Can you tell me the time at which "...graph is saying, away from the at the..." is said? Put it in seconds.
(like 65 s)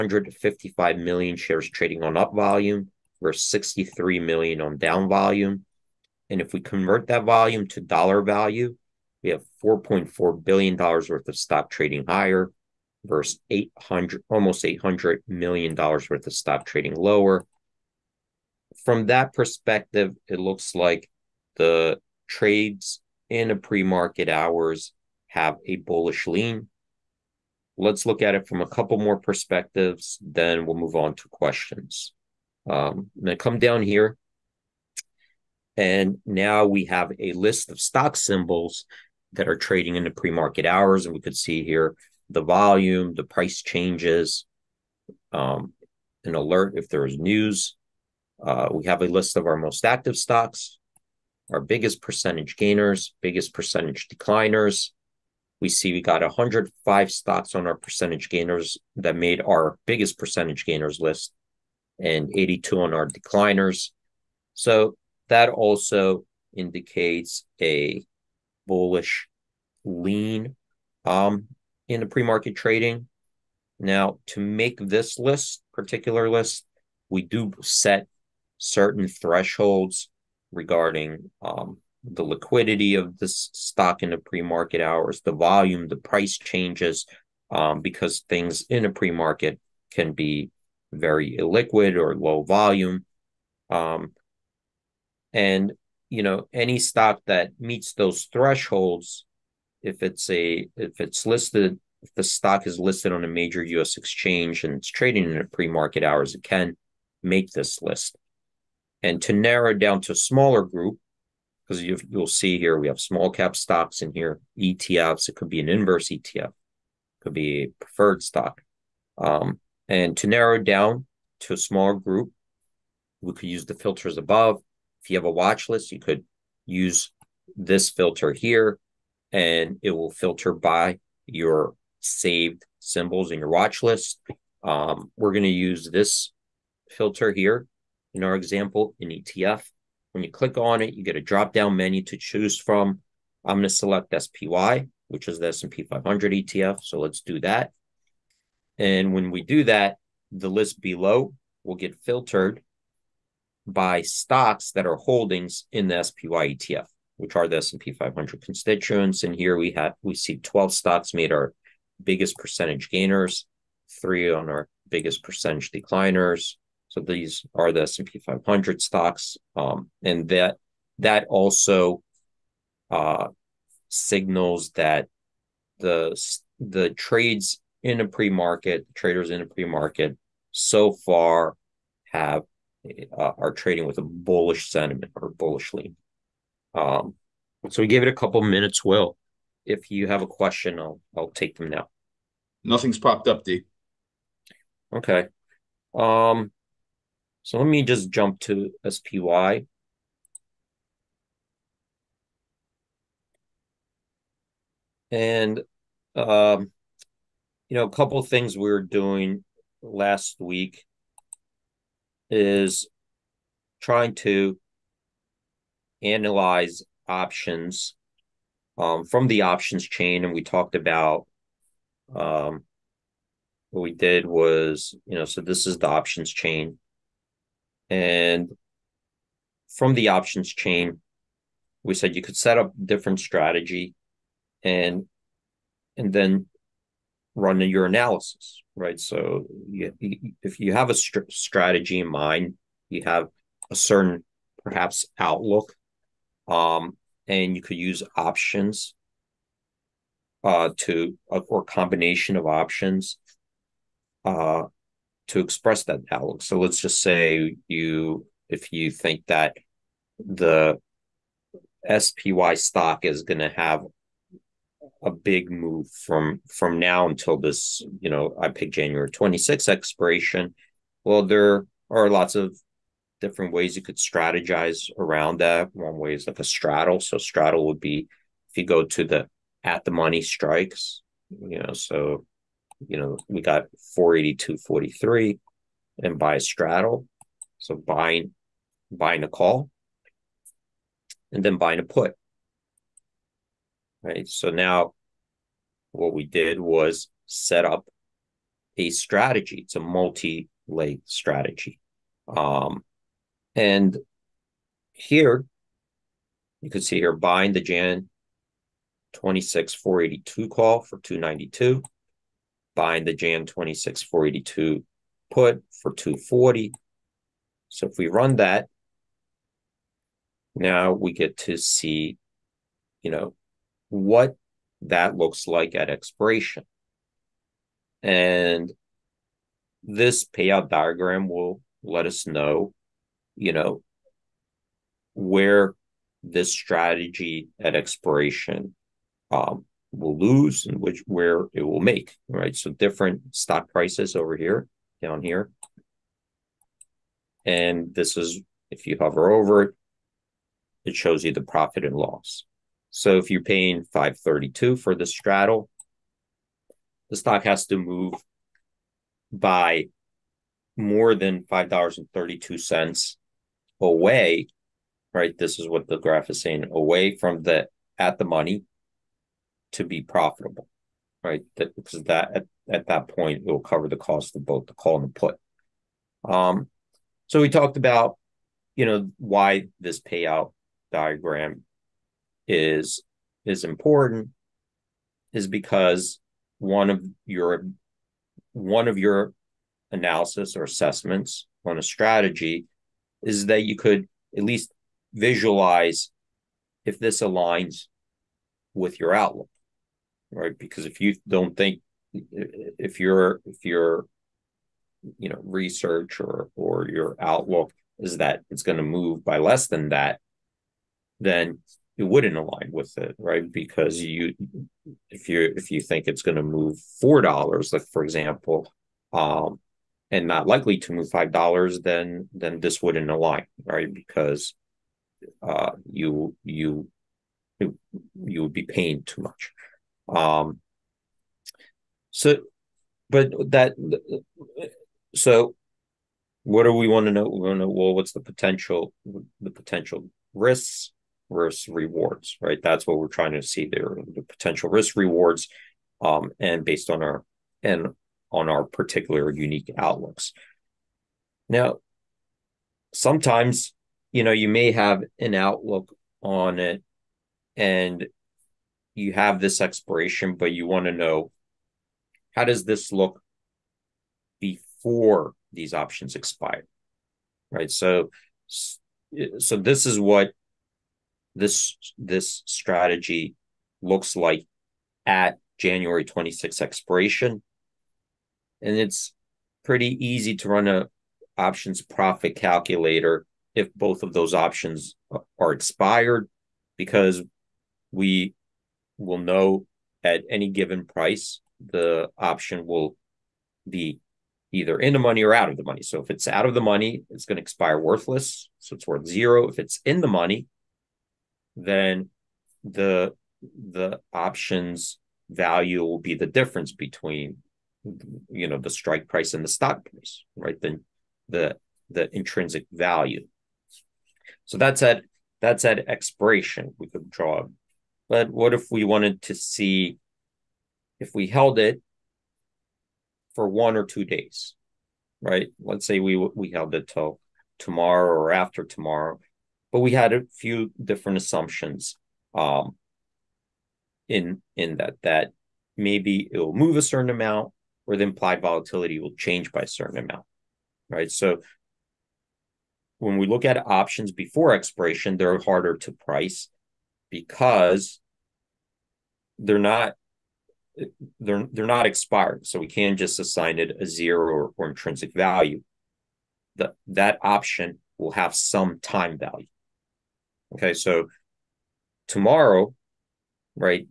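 365 s.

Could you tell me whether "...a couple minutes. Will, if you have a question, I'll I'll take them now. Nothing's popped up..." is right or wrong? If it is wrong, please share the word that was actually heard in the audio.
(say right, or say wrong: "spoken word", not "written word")
right.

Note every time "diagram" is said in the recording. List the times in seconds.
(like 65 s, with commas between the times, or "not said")
330 s, 380 s.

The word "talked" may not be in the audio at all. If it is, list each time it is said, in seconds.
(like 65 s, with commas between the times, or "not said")
220 s, 377 s.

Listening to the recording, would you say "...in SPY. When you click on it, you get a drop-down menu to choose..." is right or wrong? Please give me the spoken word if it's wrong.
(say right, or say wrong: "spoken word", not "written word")
wrong: "ETF", not "SPY".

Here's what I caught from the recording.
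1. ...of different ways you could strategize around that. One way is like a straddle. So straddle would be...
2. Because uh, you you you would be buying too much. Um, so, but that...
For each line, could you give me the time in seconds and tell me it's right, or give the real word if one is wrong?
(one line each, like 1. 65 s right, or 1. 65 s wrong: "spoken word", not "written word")
1. 272 s right
2. 423 s wrong: "paying", not "buying".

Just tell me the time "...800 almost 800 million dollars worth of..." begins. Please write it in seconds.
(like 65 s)
13 s.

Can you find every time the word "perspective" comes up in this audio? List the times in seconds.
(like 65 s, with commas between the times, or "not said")
19 s, 29 s.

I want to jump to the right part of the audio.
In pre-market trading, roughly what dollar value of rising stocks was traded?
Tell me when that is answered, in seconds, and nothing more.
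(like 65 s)
9 s.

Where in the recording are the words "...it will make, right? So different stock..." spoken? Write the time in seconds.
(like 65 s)
341 s.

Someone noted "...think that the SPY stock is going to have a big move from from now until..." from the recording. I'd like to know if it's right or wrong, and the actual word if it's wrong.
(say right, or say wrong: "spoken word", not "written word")
right.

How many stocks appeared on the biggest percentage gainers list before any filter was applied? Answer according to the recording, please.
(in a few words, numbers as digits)
105.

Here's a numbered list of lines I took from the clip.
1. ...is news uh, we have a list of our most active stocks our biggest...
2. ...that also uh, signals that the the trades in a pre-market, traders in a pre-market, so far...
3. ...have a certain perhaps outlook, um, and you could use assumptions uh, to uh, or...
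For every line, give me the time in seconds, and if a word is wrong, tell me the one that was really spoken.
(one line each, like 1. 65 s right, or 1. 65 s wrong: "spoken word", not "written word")
1. 47 s right
2. 170 s right
3. 243 s wrong: "options", not "assumptions".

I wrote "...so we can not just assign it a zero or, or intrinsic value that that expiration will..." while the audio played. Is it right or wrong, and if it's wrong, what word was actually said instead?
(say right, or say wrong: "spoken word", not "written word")
wrong: "option", not "expiration".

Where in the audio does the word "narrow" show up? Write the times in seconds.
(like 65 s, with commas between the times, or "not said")
109 s, 120 s.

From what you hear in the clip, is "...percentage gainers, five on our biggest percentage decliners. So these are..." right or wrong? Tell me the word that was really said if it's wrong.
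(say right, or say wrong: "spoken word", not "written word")
wrong: "three", not "five".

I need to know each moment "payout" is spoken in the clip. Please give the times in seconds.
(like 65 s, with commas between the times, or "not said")
330 s, 380 s.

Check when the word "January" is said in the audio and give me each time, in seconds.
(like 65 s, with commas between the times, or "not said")
268 s, 475 s.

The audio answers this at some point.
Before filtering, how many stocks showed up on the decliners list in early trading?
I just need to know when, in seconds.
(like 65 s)
62 s.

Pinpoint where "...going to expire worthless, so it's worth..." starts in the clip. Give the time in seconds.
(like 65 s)
497 s.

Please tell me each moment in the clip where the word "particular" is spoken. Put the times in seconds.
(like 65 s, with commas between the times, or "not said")
75 s, 448 s.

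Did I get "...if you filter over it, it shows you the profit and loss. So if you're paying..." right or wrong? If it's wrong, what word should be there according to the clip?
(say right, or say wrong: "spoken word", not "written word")
wrong: "hover", not "filter".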